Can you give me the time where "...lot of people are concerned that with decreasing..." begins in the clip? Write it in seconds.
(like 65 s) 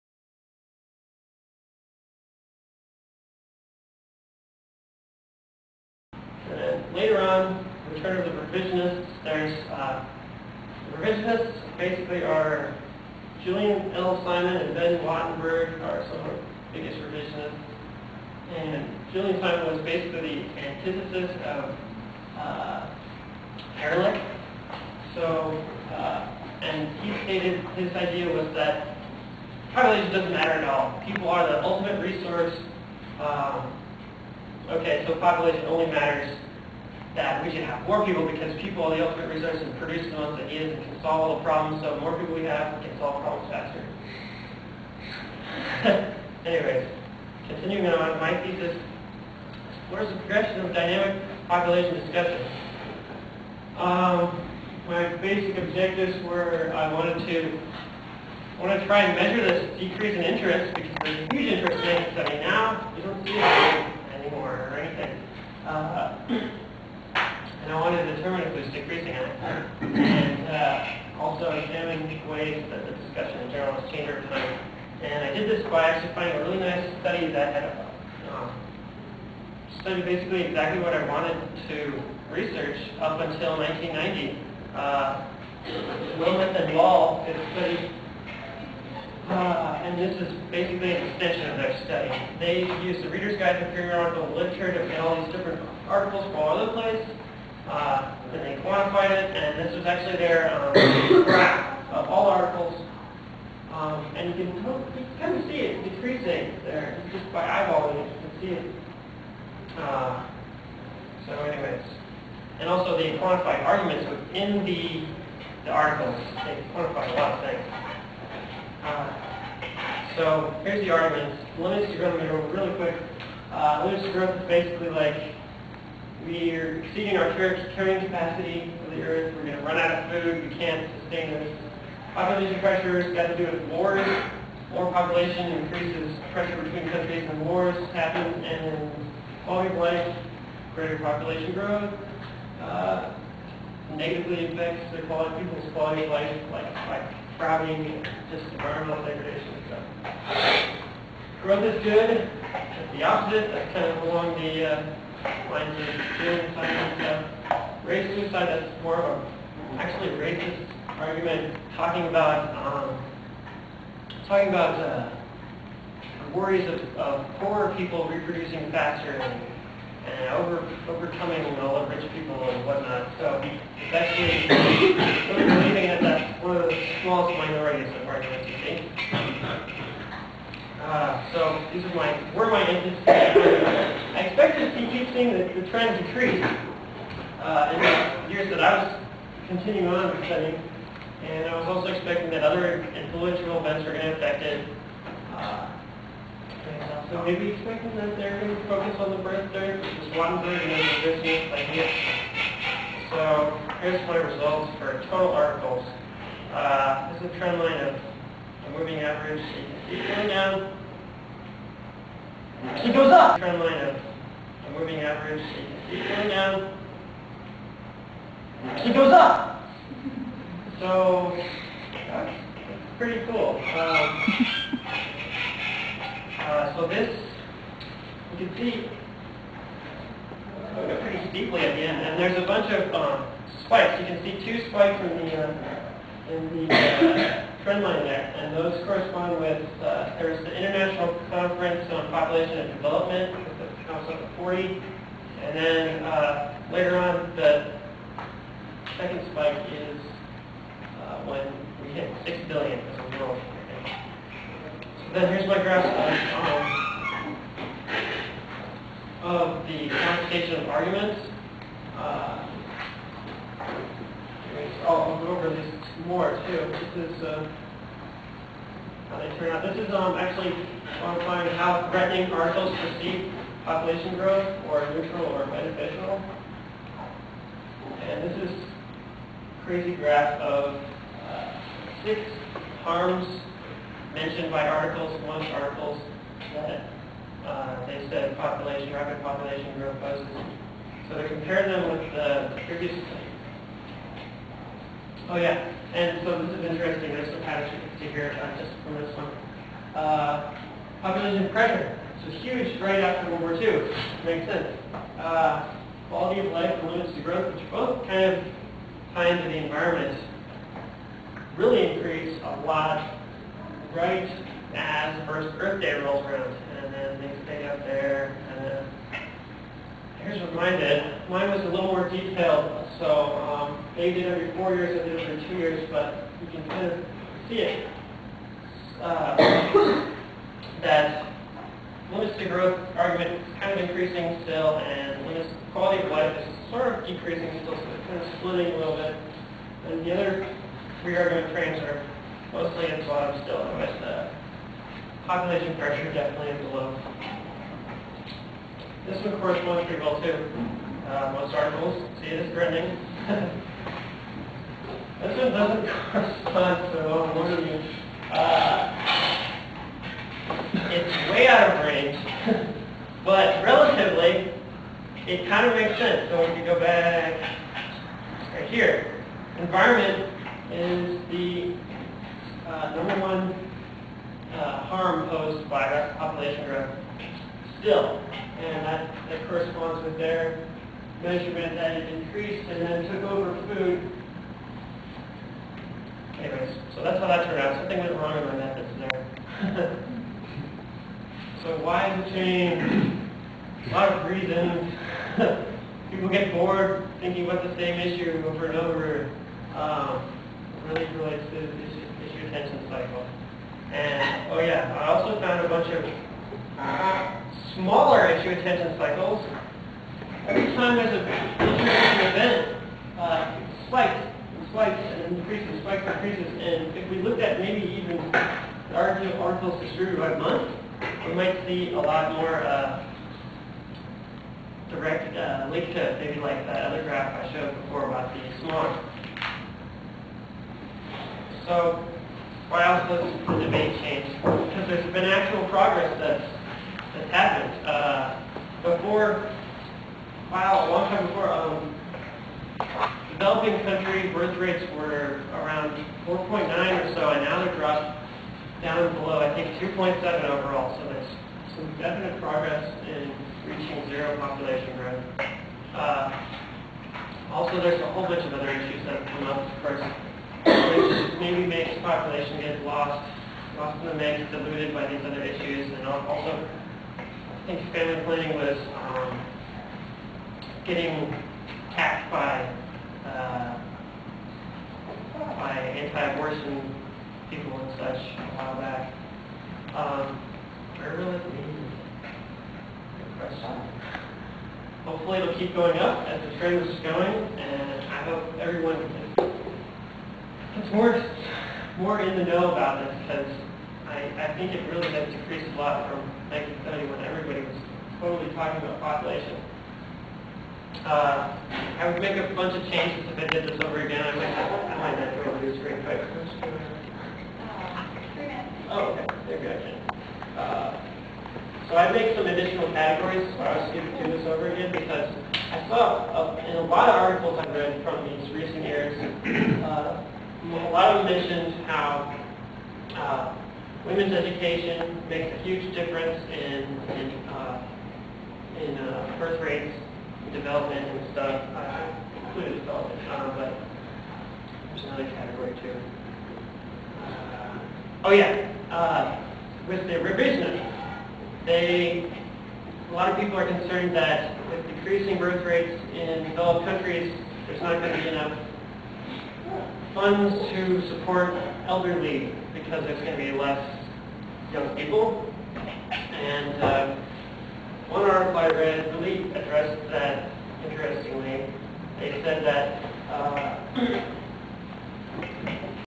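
543 s.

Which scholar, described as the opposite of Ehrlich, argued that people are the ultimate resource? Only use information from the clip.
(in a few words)
Julian L. Simon.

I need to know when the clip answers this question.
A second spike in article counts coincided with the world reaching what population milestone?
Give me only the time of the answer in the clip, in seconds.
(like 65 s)
252 s.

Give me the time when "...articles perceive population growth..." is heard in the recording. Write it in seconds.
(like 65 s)
272 s.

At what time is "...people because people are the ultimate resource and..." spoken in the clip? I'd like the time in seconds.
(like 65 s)
38 s.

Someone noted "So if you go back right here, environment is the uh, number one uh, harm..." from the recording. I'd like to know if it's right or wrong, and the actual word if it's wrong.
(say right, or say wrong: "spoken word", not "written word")
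right.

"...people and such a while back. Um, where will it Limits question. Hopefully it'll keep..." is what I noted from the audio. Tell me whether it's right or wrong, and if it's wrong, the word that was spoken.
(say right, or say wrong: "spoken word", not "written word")
wrong: "Good", not "Limits".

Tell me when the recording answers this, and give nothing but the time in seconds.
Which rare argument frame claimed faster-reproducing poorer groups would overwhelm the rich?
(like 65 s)
157 s.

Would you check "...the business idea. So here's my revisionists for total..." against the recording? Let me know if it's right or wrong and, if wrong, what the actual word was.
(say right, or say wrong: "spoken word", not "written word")
wrong: "results", not "revisionists".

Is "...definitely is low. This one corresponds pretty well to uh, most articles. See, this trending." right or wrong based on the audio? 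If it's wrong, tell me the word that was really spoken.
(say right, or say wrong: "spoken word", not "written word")
right.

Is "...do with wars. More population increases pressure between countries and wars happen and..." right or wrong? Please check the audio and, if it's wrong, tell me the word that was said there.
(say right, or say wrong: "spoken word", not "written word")
right.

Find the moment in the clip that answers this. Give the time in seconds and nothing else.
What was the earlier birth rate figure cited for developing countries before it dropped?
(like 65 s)
446 s.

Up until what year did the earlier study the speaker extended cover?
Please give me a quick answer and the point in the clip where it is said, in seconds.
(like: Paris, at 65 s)
1990, at 83 s.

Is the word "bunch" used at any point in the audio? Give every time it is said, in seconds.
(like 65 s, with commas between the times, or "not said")
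232 s, 405 s, 458 s, 502 s.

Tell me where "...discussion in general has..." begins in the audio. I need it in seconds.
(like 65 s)
72 s.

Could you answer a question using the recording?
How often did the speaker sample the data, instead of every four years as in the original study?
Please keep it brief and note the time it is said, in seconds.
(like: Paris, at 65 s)
every 2 years, at 325 s.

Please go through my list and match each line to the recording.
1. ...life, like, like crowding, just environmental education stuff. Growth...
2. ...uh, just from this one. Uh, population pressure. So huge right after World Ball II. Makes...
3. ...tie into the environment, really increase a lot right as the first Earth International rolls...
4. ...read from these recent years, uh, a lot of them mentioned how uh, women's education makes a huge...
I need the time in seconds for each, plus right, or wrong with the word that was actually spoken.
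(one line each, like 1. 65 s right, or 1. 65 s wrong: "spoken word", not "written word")
1. 146 s wrong: "degradation", not "education"
2. 298 s wrong: "War", not "Ball"
3. 309 s wrong: "Day", not "International"
4. 517 s right.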